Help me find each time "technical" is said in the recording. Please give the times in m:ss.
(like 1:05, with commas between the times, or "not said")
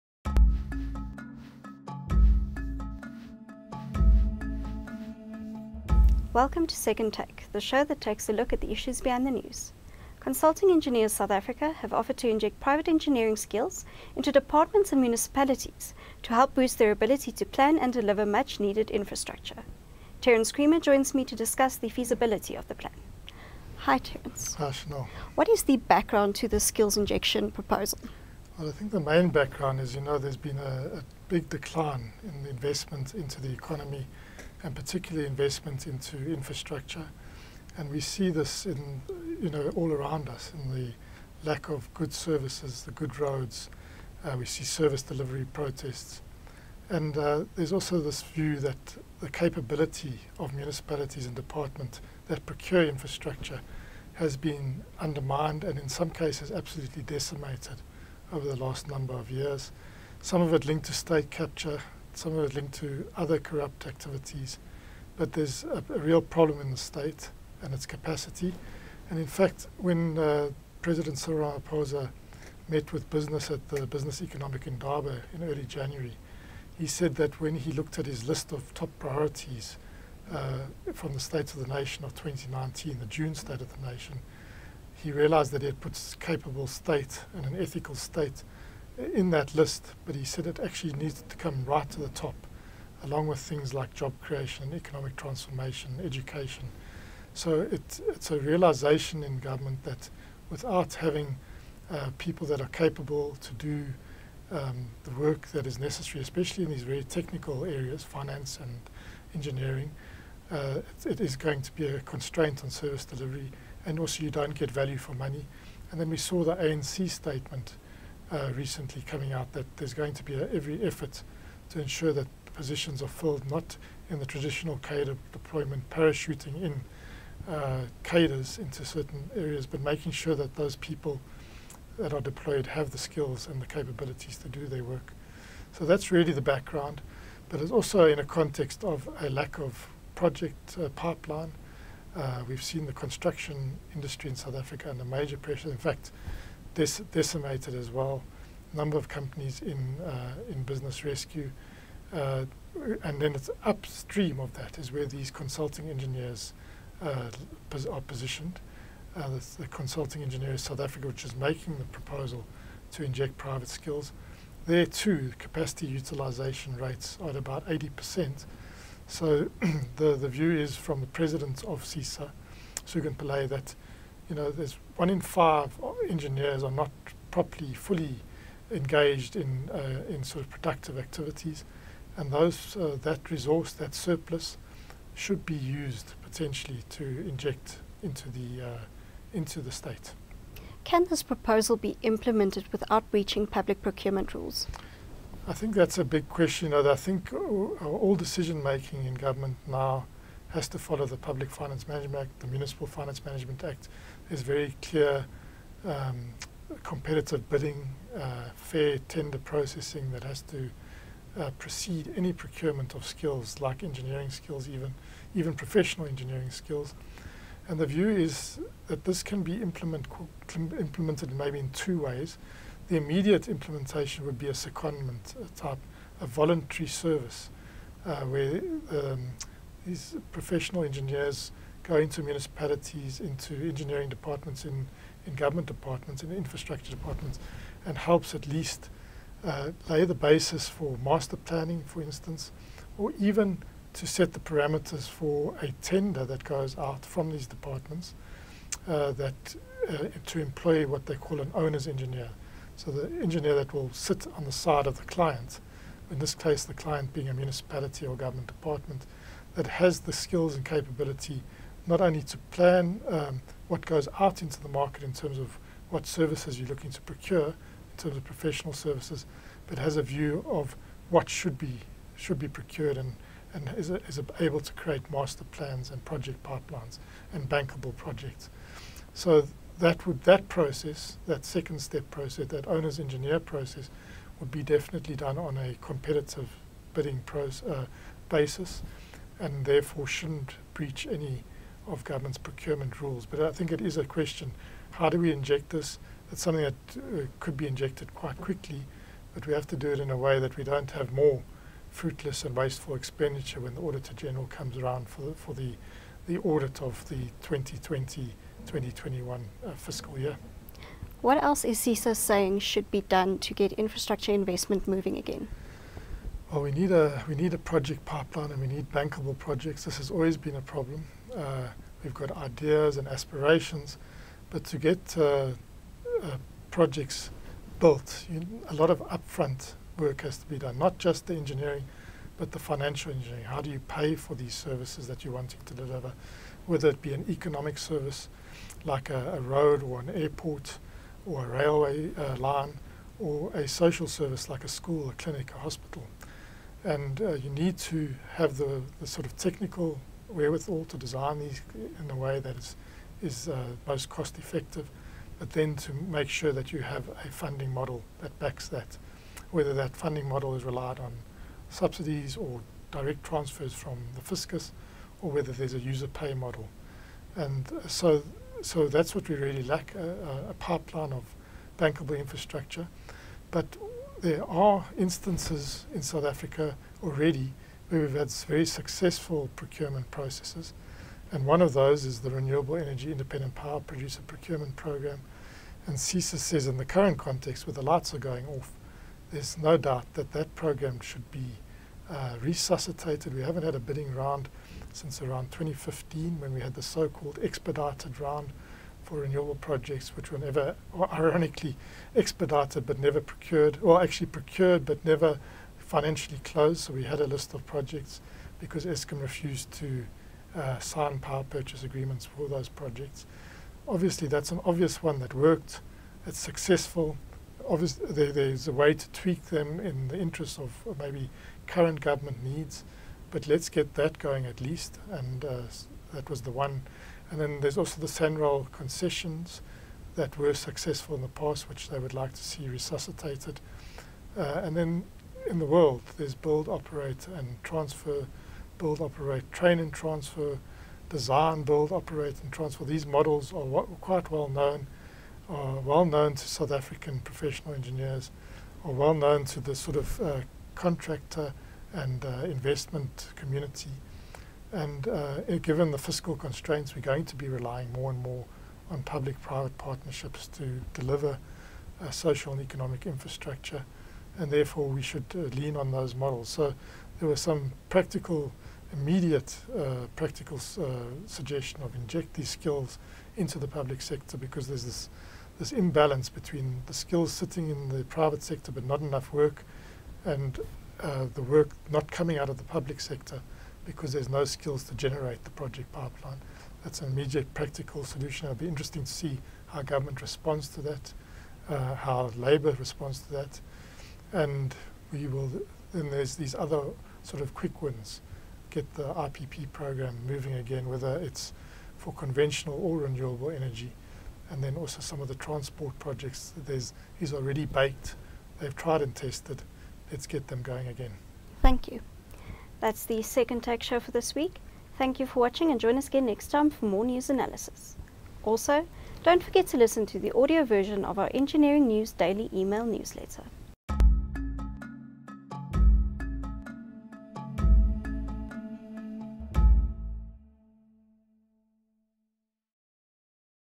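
1:47, 5:49.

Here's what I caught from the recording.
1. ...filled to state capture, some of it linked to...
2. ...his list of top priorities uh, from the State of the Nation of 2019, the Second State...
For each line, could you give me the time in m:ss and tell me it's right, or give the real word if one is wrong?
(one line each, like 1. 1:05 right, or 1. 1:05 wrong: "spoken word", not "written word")
1. 1:00 wrong: "linked", not "filled"
2. 1:18 wrong: "June", not "Second".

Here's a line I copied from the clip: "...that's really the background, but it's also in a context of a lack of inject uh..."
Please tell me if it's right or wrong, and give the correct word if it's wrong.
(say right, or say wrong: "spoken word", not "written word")
wrong: "project", not "inject".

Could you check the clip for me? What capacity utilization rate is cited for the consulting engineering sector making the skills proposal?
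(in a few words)
80%.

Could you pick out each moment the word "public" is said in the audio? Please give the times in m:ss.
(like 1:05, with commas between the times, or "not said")
3:13, 3:21, 7:39, 7:53, 8:02.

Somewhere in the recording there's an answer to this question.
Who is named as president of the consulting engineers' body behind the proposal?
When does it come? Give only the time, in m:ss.
2:52.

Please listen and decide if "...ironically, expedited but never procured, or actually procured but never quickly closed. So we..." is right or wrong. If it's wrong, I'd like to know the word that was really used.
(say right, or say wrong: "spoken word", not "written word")
wrong: "financially", not "quickly".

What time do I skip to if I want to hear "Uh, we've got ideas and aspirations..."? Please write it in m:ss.
5:21.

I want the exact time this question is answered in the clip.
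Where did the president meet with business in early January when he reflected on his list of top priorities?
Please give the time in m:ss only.
1:14.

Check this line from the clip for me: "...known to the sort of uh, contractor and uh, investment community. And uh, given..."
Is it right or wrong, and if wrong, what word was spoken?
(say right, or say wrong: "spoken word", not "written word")
right.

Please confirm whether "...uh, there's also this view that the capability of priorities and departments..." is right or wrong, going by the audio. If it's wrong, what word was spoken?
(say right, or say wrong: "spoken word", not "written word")
wrong: "municipalities", not "priorities".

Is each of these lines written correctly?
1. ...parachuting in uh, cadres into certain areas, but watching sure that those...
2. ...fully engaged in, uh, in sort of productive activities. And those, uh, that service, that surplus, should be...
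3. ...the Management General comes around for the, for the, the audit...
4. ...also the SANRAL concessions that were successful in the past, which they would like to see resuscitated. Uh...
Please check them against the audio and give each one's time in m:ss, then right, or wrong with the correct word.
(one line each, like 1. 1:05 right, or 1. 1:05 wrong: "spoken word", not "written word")
1. 2:05 wrong: "making", not "watching"
2. 2:57 wrong: "resource", not "service"
3. 5:03 wrong: "Auditor", not "Management"
4. 7:07 right.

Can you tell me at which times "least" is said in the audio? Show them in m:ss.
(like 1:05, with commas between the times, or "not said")
3:58, 7:04.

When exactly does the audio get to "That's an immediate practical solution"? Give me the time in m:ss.
8:06.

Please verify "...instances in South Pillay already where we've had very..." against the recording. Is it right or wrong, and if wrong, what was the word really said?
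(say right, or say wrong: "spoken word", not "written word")
wrong: "Africa", not "Pillay".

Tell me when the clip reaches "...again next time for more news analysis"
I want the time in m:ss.
8:36.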